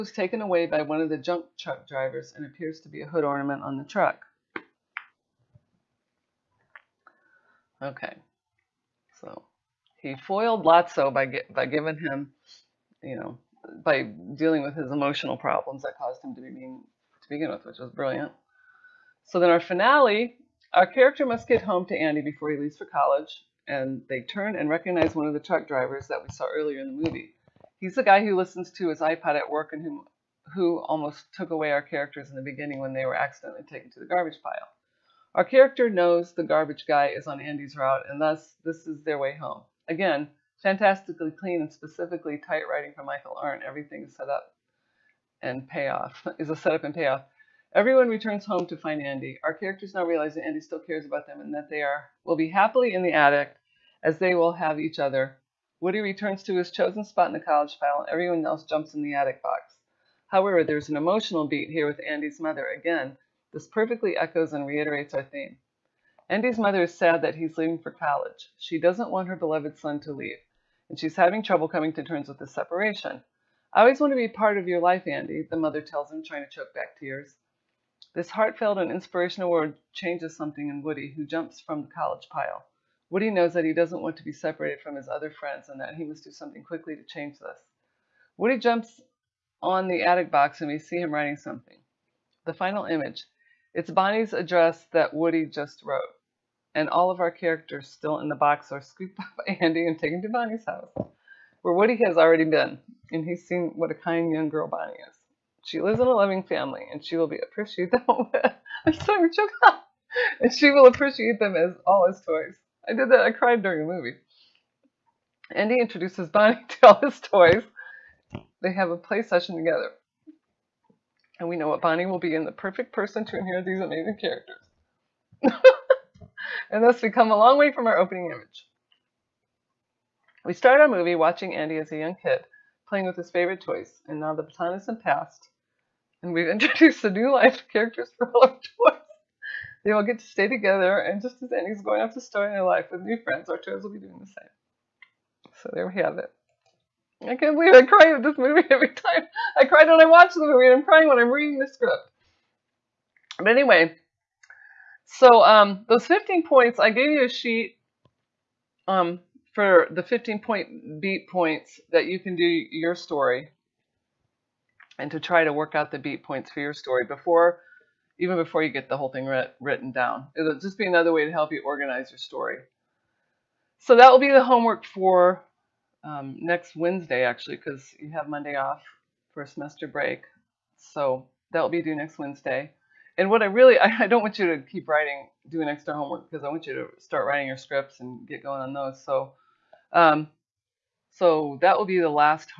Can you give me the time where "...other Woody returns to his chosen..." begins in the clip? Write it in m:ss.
0:54.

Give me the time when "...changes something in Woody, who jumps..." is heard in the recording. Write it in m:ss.
1:19.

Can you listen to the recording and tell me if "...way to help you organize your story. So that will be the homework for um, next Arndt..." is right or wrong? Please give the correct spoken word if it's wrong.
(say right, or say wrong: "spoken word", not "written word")
wrong: "Wednesday", not "Arndt".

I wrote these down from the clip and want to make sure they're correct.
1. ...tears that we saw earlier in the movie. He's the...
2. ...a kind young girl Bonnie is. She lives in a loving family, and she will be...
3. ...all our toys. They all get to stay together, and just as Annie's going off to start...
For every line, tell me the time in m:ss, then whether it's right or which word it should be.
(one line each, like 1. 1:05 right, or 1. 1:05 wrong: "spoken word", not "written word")
1. 0:25 wrong: "drivers", not "tears"
2. 1:43 right
3. 2:18 right.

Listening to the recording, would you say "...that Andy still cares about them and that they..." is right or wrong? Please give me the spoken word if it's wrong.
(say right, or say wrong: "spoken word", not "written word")
right.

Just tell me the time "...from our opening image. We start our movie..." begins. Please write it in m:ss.
2:07.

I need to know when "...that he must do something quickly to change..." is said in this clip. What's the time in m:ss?
1:25.